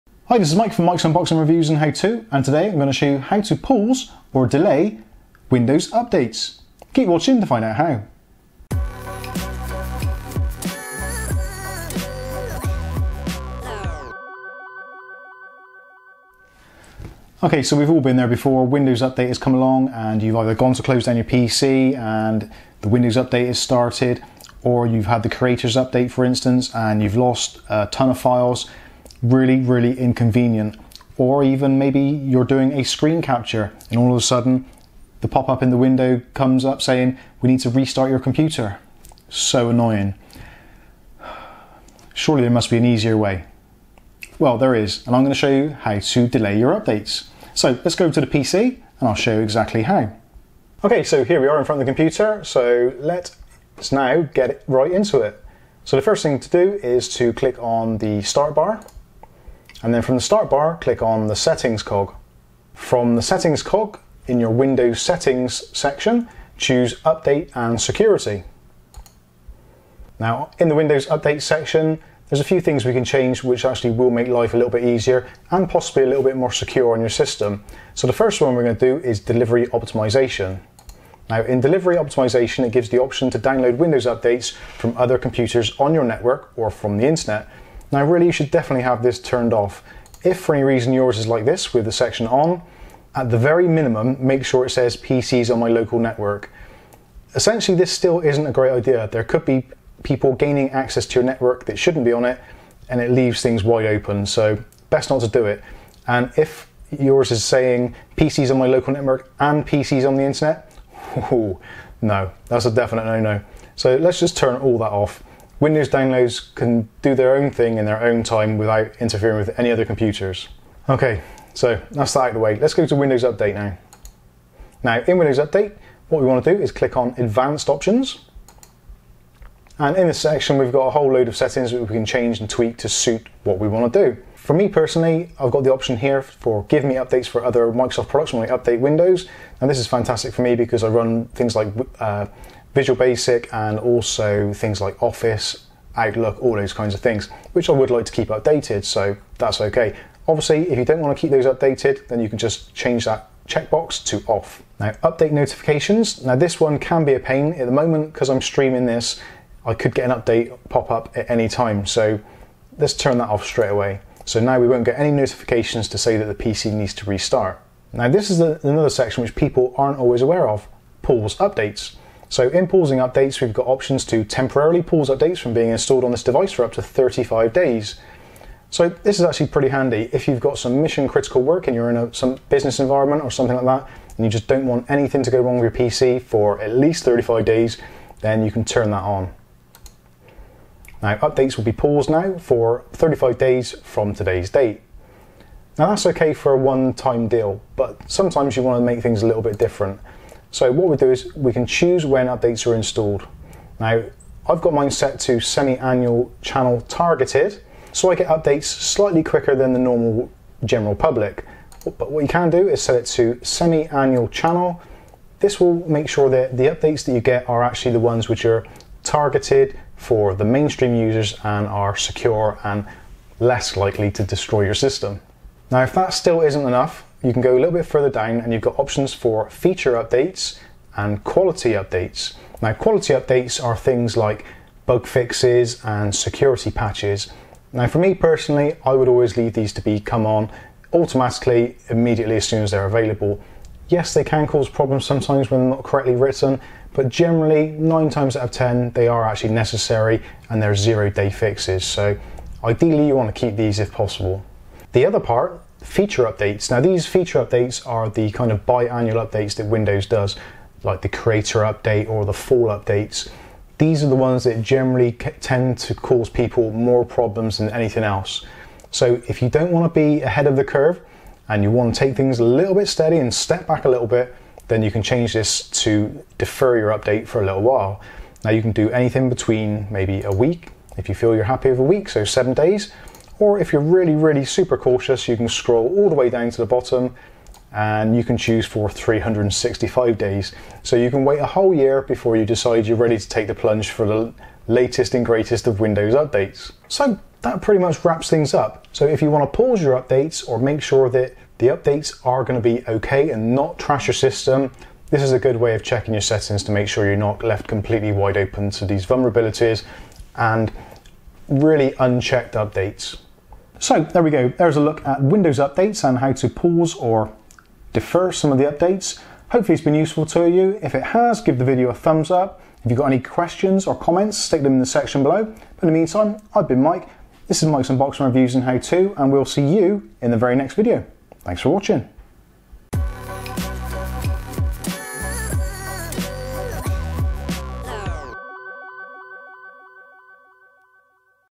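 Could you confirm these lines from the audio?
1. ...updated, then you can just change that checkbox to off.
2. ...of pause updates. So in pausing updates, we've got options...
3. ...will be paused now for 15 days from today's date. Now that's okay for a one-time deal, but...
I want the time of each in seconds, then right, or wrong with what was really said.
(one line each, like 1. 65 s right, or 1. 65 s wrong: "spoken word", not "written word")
1. 151 s right
2. 170 s right
3. 191 s wrong: "35", not "15".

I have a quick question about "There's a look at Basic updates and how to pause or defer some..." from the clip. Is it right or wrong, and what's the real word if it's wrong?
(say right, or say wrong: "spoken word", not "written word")
wrong: "Windows", not "Basic".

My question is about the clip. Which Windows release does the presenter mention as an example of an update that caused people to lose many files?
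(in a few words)
Creators Update.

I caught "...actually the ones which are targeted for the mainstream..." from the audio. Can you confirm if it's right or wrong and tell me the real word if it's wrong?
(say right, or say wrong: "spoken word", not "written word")
right.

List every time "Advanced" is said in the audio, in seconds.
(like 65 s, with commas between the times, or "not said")
127 s.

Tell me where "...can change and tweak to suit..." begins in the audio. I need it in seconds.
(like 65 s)
131 s.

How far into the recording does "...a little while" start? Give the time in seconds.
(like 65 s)
277 s.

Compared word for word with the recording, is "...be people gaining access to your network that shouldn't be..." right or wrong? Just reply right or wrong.
right.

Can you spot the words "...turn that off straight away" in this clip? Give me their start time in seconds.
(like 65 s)
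162 s.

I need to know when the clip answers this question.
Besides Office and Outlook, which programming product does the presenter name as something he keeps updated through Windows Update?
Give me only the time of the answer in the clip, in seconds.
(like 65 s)
142 s.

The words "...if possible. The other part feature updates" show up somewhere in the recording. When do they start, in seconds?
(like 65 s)
253 s.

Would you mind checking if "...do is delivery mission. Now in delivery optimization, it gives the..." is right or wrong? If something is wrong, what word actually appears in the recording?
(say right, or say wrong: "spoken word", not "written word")
wrong: "optimization", not "mission".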